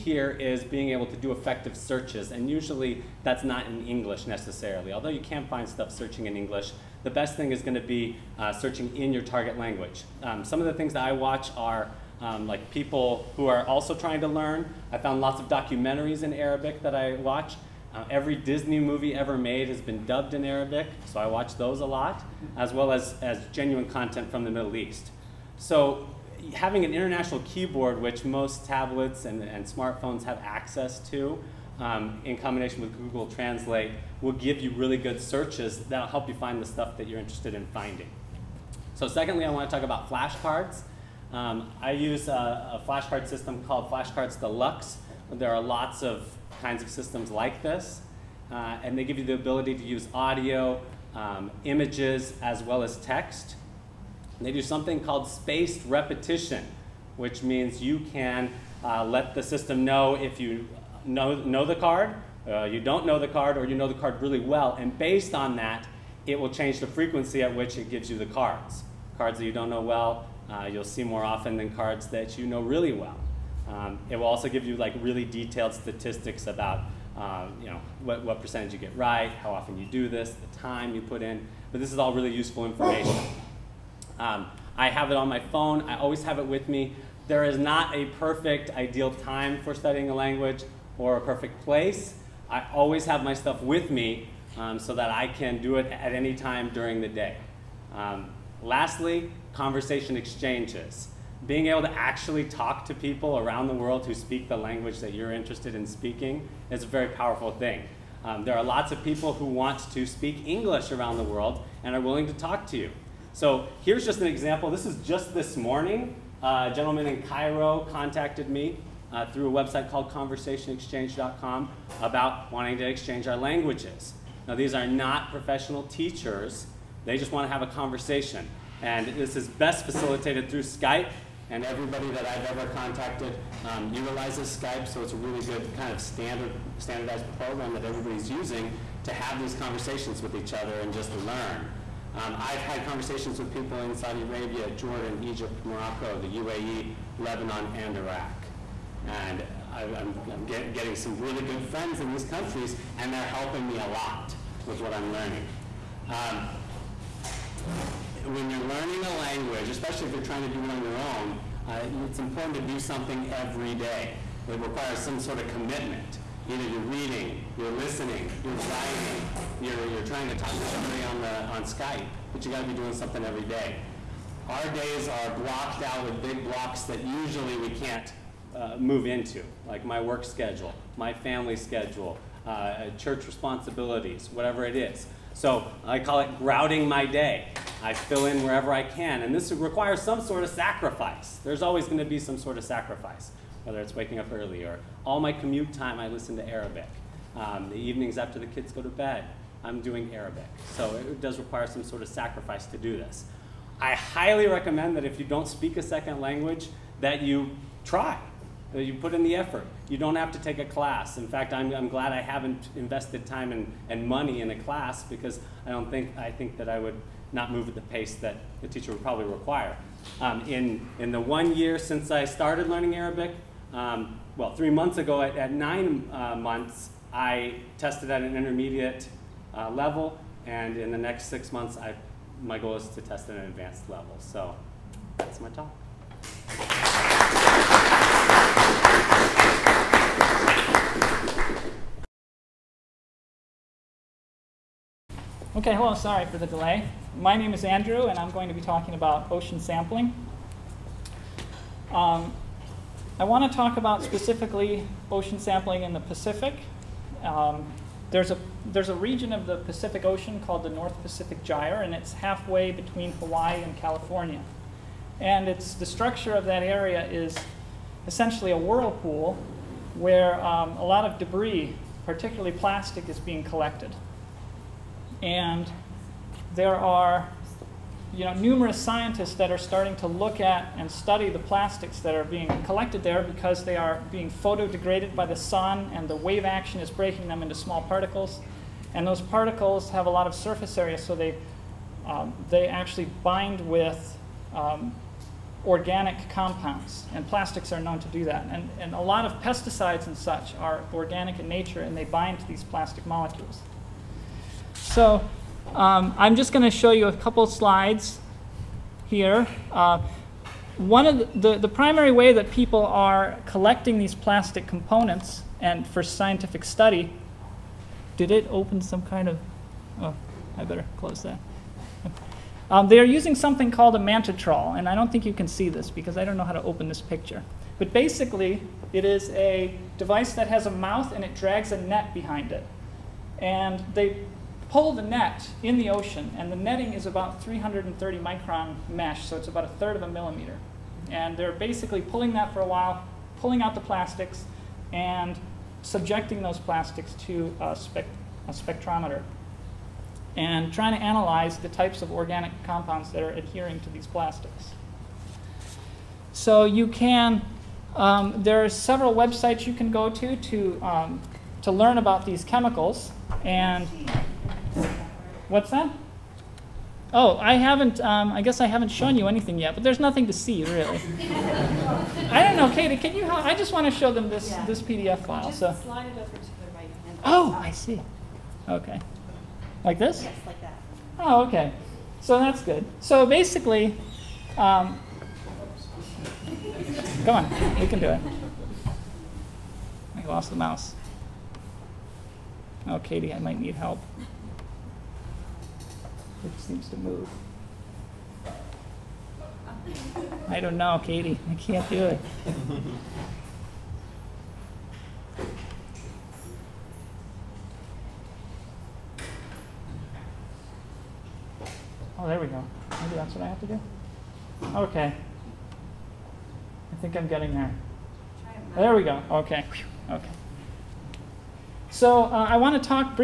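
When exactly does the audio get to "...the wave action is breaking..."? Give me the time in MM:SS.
04:46.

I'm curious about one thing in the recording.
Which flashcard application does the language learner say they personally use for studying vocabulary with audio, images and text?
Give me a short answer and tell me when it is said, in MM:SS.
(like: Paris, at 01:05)
Flashcards Deluxe, at 00:43.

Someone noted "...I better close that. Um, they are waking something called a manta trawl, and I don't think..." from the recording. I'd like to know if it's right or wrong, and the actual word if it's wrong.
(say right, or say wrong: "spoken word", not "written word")
wrong: "using", not "waking".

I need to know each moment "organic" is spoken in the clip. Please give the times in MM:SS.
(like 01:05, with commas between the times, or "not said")
04:55, 05:00, 05:52.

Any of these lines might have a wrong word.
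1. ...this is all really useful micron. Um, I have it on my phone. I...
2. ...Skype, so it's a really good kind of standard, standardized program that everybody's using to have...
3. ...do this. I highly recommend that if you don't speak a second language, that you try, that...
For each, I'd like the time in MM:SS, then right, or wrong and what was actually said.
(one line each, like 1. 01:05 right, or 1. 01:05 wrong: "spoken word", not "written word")
1. 01:21 wrong: "information", not "micron"
2. 02:14 right
3. 03:22 right.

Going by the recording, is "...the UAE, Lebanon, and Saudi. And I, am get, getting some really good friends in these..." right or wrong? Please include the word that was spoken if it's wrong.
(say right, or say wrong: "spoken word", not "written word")
wrong: "Iraq", not "Saudi".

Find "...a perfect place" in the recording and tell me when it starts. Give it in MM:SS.
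01:31.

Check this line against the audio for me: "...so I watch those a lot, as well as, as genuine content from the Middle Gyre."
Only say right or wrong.
wrong.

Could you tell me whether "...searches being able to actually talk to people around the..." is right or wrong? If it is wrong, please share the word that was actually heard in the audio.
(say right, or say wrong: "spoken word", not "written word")
wrong: "exchanges", not "searches".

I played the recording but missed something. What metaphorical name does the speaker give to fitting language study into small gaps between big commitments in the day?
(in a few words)
grouting my day.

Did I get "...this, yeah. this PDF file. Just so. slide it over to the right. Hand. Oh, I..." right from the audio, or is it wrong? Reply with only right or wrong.
right.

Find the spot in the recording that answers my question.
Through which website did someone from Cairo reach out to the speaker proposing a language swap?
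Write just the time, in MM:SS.
02:00.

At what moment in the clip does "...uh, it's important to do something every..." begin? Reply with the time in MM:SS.
02:41.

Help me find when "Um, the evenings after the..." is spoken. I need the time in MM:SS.
03:17.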